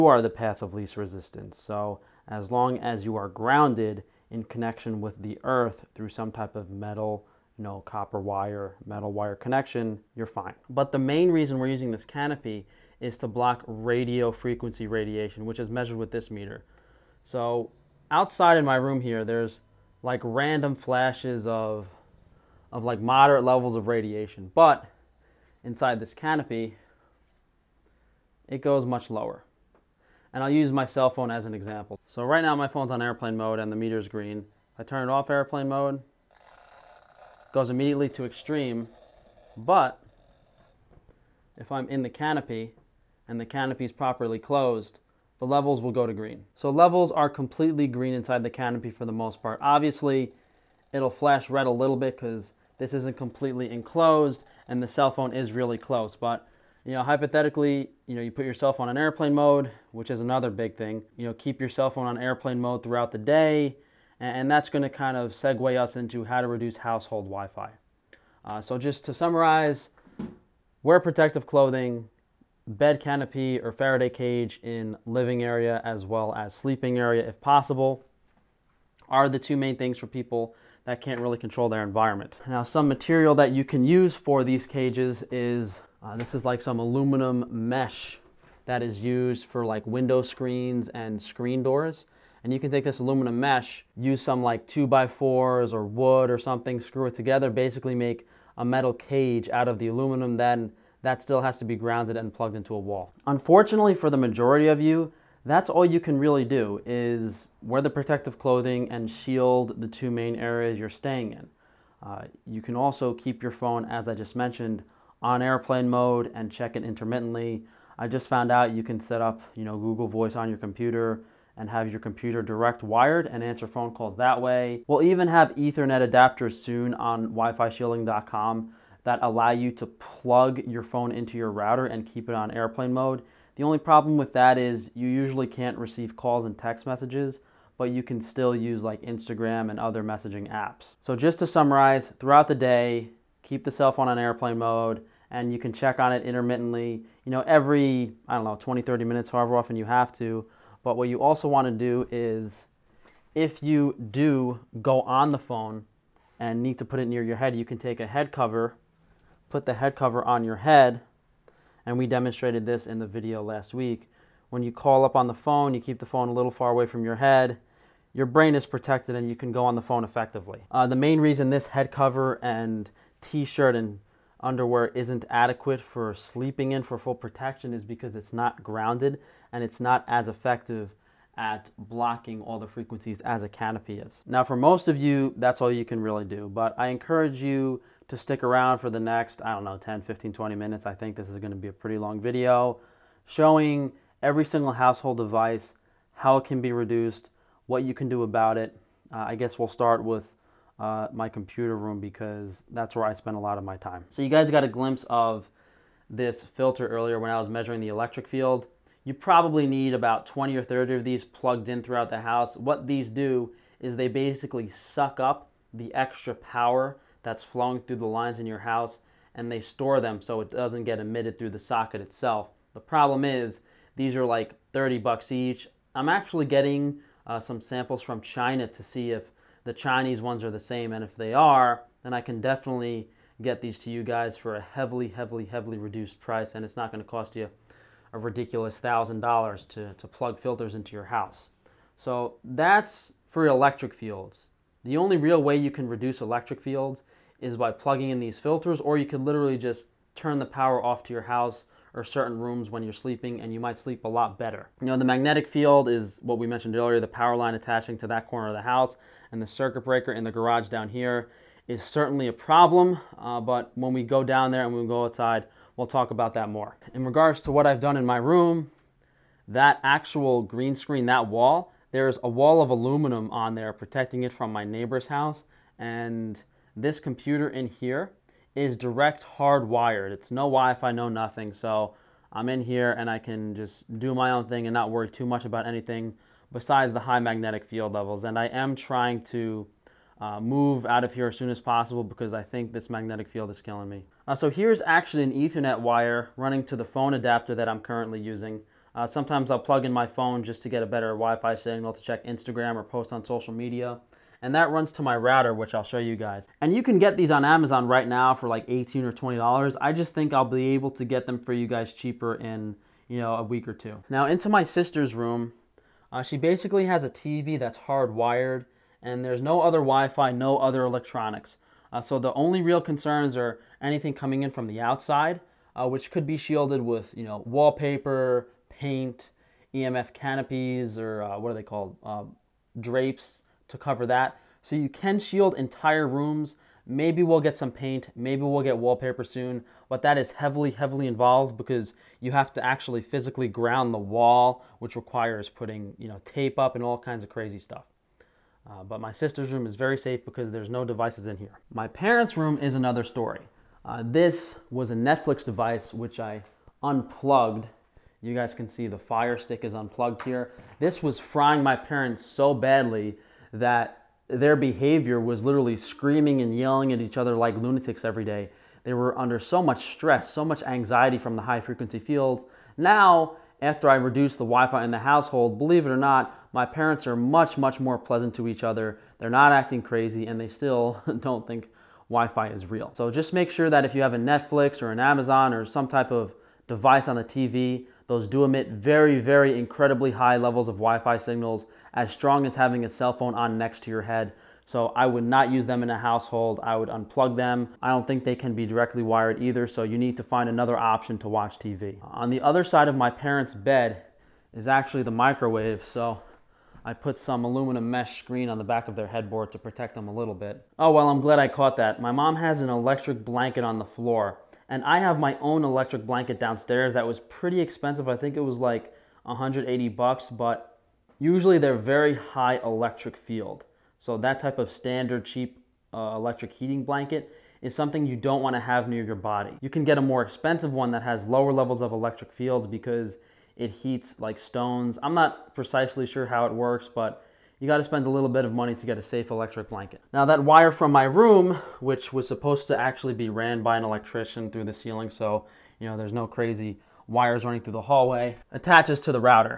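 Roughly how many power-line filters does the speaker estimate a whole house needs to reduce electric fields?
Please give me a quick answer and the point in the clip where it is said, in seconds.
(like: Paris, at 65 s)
20 or 30, at 210 s.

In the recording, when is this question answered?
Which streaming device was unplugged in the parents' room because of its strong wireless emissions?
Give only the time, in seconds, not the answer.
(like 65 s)
358 s.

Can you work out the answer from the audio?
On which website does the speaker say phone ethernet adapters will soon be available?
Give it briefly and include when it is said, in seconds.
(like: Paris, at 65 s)
wifishielding.com, at 127 s.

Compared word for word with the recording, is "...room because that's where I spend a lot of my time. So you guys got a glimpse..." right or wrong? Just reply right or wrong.
right.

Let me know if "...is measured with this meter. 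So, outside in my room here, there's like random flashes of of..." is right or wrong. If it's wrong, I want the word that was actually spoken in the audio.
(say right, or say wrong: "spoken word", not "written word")
right.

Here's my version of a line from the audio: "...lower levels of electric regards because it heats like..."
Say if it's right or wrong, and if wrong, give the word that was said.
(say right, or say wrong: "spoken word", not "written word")
wrong: "fields", not "regards".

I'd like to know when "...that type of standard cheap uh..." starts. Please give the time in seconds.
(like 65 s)
424 s.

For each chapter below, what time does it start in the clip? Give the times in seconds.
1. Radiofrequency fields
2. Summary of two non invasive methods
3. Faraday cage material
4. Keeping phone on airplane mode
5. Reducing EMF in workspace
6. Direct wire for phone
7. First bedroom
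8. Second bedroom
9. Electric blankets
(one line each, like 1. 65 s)
1. 10 s
2. 67 s
3. 82 s
4. 111 s
5. 203 s
6. 293 s
7. 313 s
8. 351 s
9. 410 s.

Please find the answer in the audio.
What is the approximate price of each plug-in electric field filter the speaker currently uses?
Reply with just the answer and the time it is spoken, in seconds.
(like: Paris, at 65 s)
30 dollars, at 224 s.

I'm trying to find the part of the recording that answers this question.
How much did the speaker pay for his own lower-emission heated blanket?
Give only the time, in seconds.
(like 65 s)
419 s.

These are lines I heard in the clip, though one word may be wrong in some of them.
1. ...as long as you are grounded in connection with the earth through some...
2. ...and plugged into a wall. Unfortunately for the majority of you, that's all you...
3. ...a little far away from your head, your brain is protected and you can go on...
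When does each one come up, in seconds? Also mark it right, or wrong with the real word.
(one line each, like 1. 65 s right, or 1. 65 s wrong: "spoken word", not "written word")
1. 2 s right
2. 102 s right
3. 166 s right.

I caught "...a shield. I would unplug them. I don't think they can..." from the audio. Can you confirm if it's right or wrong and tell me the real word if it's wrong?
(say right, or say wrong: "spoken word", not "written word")
wrong: "household", not "shield".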